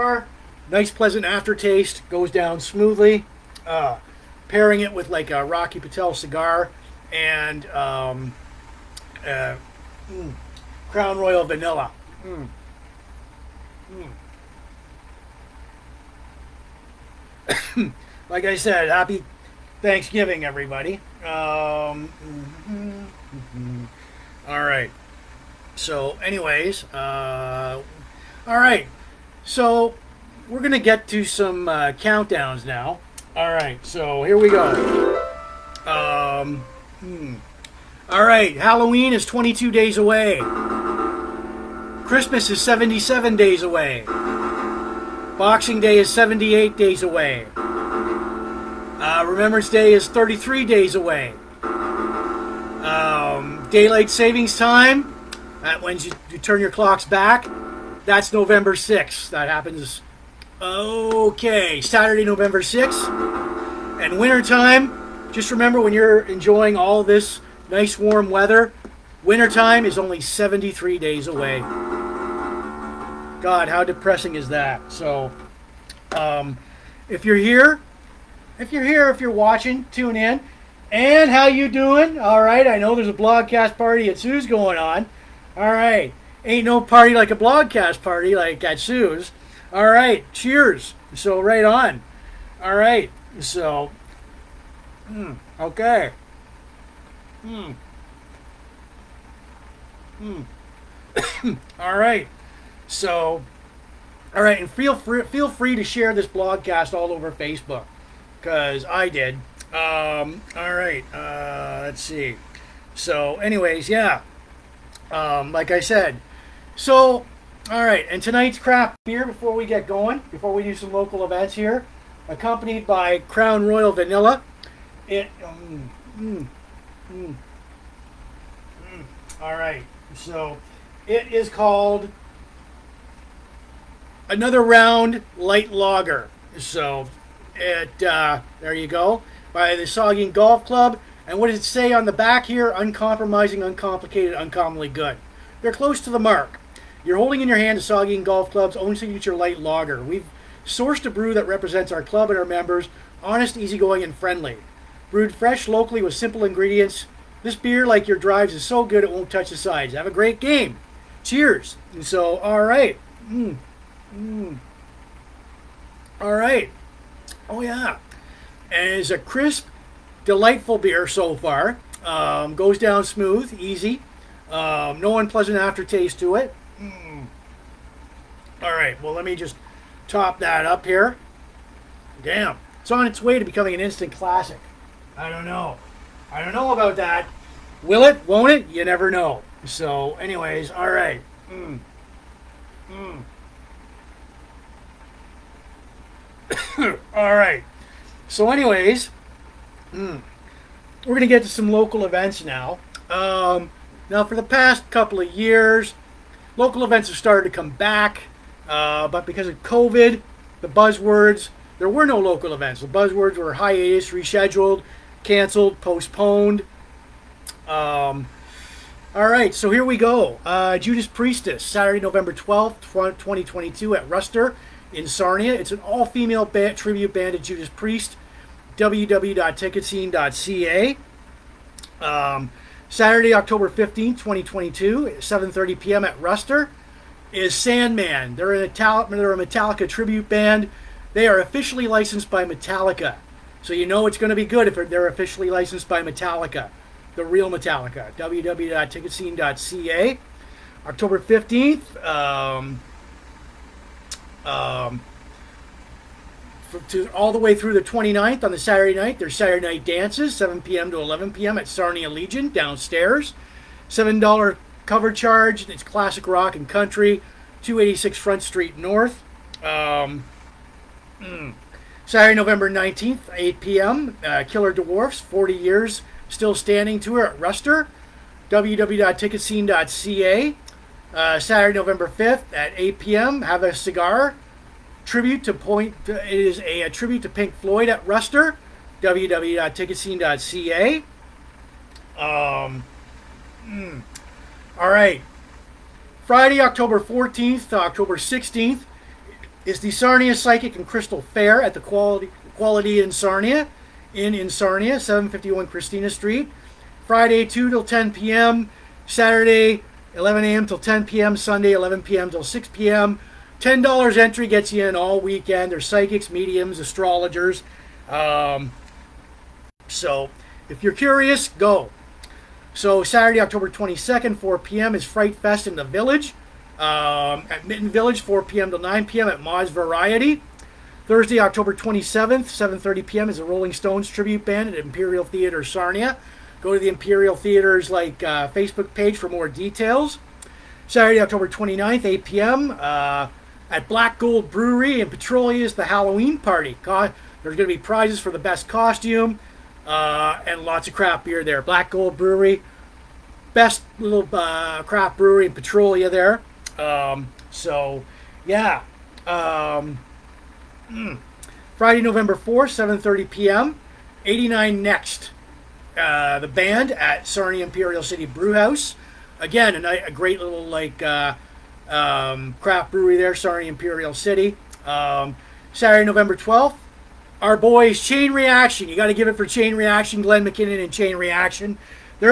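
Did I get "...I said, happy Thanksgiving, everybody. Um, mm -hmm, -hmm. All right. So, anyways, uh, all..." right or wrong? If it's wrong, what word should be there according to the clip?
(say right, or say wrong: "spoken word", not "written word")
right.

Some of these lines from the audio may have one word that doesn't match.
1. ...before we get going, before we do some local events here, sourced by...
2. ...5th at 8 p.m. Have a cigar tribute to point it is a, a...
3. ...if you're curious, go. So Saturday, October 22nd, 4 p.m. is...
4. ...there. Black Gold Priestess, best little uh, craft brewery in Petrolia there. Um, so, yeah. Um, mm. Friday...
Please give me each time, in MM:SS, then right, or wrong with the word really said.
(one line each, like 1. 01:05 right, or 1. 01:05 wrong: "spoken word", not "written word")
1. 01:59 wrong: "accompanied", not "sourced"
2. 04:42 right
3. 05:20 right
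4. 05:51 wrong: "Brewery", not "Priestess".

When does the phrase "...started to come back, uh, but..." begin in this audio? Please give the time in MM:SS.
03:27.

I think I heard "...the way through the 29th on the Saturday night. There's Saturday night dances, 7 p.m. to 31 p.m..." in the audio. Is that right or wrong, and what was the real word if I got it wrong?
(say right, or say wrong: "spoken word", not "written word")
wrong: "11", not "31".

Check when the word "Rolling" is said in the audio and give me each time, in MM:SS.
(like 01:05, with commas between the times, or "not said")
05:33.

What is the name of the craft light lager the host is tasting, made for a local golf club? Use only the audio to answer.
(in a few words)
Another Round.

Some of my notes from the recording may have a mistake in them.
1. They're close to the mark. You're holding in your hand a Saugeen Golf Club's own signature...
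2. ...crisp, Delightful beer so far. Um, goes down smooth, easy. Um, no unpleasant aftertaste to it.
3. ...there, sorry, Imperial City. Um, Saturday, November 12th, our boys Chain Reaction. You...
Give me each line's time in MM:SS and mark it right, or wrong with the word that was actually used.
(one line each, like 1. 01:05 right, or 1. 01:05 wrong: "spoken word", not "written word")
1. 02:25 right
2. 02:49 right
3. 06:13 right.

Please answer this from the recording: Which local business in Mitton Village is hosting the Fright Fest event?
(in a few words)
Moz Variety.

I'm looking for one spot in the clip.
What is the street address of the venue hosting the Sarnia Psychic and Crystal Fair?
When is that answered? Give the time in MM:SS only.
05:05.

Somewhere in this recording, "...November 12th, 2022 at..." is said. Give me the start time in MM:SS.
03:42.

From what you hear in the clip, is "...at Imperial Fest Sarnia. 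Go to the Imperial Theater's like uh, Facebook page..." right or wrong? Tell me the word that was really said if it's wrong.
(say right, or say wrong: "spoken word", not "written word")
wrong: "Theatre", not "Fest".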